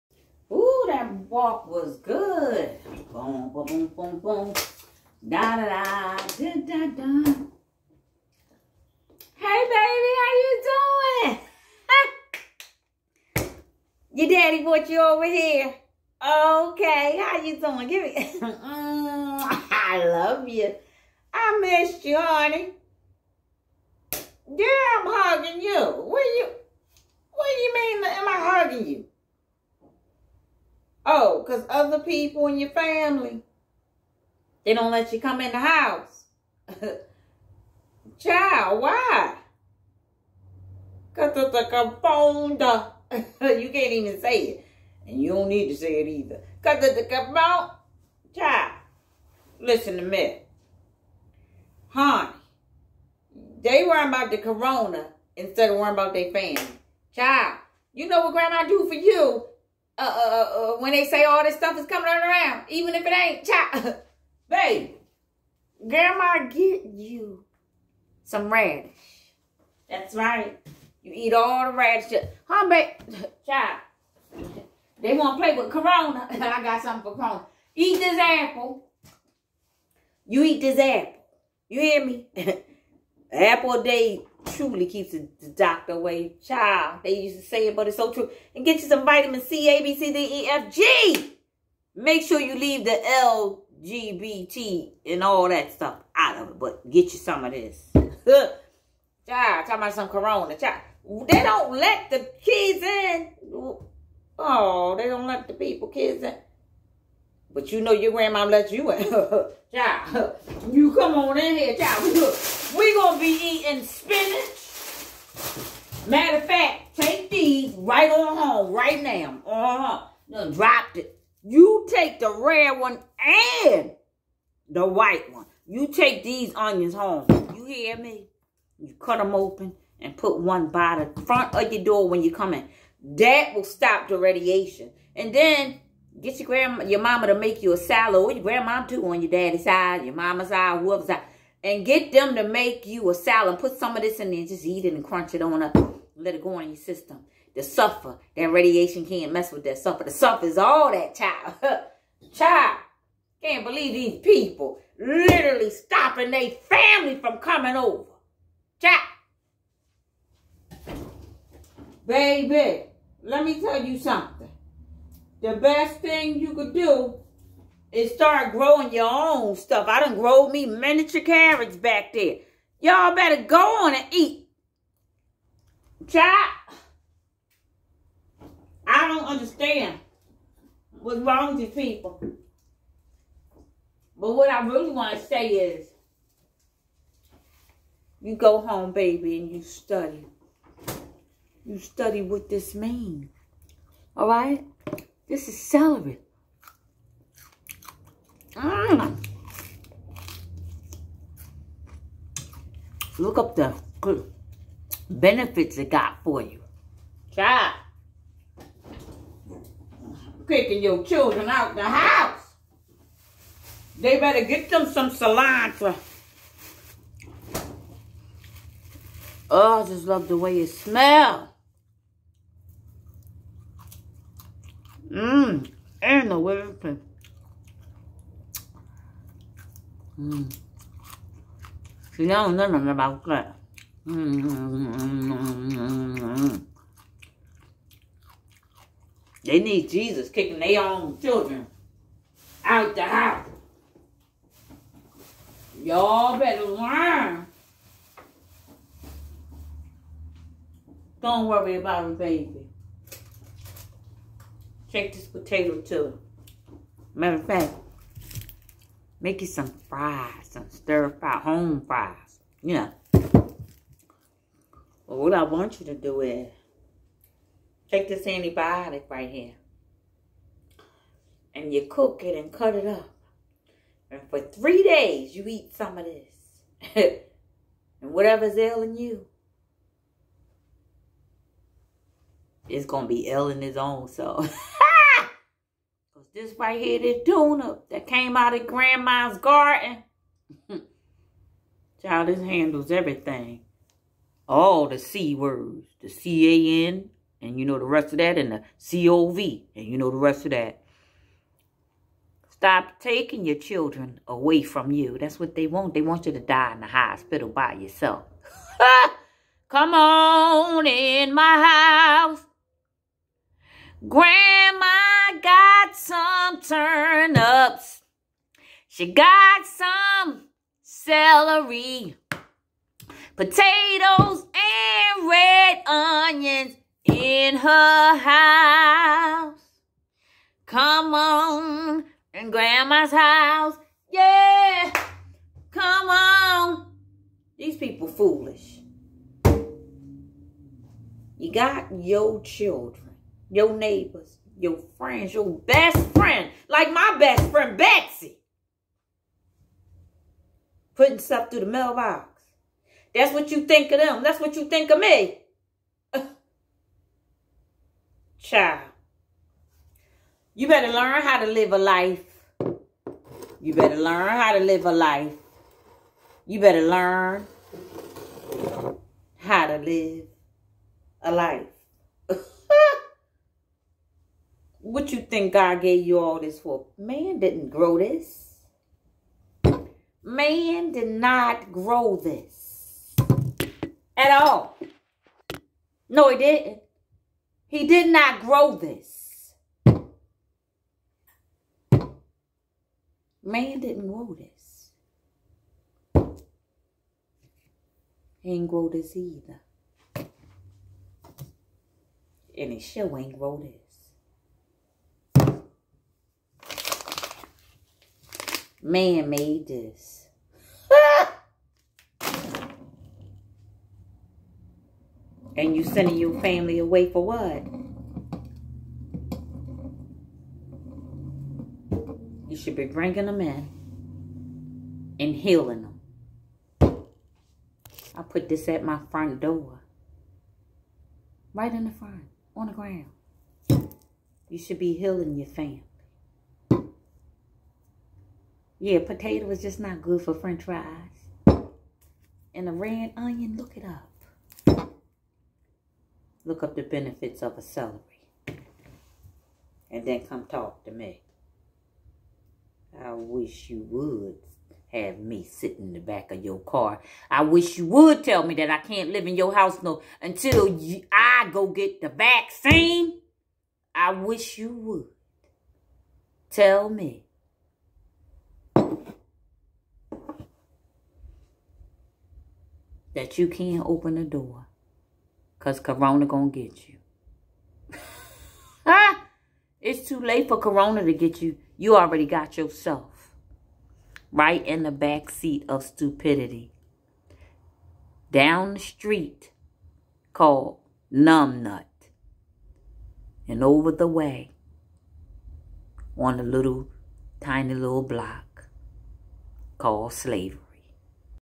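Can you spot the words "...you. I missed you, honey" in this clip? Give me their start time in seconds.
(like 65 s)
20 s.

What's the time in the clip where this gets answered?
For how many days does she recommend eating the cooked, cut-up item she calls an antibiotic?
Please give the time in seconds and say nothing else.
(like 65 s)
274 s.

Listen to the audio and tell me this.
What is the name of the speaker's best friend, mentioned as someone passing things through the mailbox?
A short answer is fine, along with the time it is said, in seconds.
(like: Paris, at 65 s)
Betsy, at 347 s.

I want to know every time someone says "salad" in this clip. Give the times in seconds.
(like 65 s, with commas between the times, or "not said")
137 s, 143 s.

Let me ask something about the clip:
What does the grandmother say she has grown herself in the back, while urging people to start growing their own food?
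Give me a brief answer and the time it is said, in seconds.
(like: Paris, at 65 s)
miniature carrots, at 170 s.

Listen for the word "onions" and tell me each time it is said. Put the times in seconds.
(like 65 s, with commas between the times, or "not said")
126 s, 325 s, 443 s.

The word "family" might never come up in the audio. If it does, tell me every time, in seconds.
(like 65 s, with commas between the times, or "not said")
32 s, 56 s, 156 s, 416 s, 435 s.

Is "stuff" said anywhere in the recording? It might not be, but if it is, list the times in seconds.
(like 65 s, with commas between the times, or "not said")
61 s, 95 s, 169 s, 351 s.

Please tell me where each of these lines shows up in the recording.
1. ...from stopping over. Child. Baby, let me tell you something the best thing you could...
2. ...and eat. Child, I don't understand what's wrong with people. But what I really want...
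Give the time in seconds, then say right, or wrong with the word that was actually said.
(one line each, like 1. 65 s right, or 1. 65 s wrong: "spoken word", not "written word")
1. 157 s wrong: "coming", not "stopping"
2. 173 s right.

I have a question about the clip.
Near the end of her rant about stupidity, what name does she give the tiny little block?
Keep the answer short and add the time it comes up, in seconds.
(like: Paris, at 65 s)
slavery, at 500 s.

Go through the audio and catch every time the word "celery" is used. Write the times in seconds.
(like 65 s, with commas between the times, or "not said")
195 s, 320 s, 447 s.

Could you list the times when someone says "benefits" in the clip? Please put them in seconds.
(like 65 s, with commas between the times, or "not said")
205 s, 446 s.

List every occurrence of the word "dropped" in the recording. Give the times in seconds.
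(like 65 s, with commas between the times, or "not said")
120 s.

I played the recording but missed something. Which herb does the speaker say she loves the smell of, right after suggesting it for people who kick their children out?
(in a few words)
cilantro.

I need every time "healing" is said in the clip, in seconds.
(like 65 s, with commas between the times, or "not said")
425 s, 434 s.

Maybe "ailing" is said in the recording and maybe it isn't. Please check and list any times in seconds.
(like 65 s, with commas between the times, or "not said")
278 s, 283 s.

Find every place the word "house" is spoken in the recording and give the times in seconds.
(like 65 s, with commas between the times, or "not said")
35 s, 211 s, 243 s, 312 s, 328 s, 333 s, 459 s.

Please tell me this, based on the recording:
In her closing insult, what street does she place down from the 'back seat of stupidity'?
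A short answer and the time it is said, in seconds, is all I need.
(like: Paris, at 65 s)
numbnut, at 491 s.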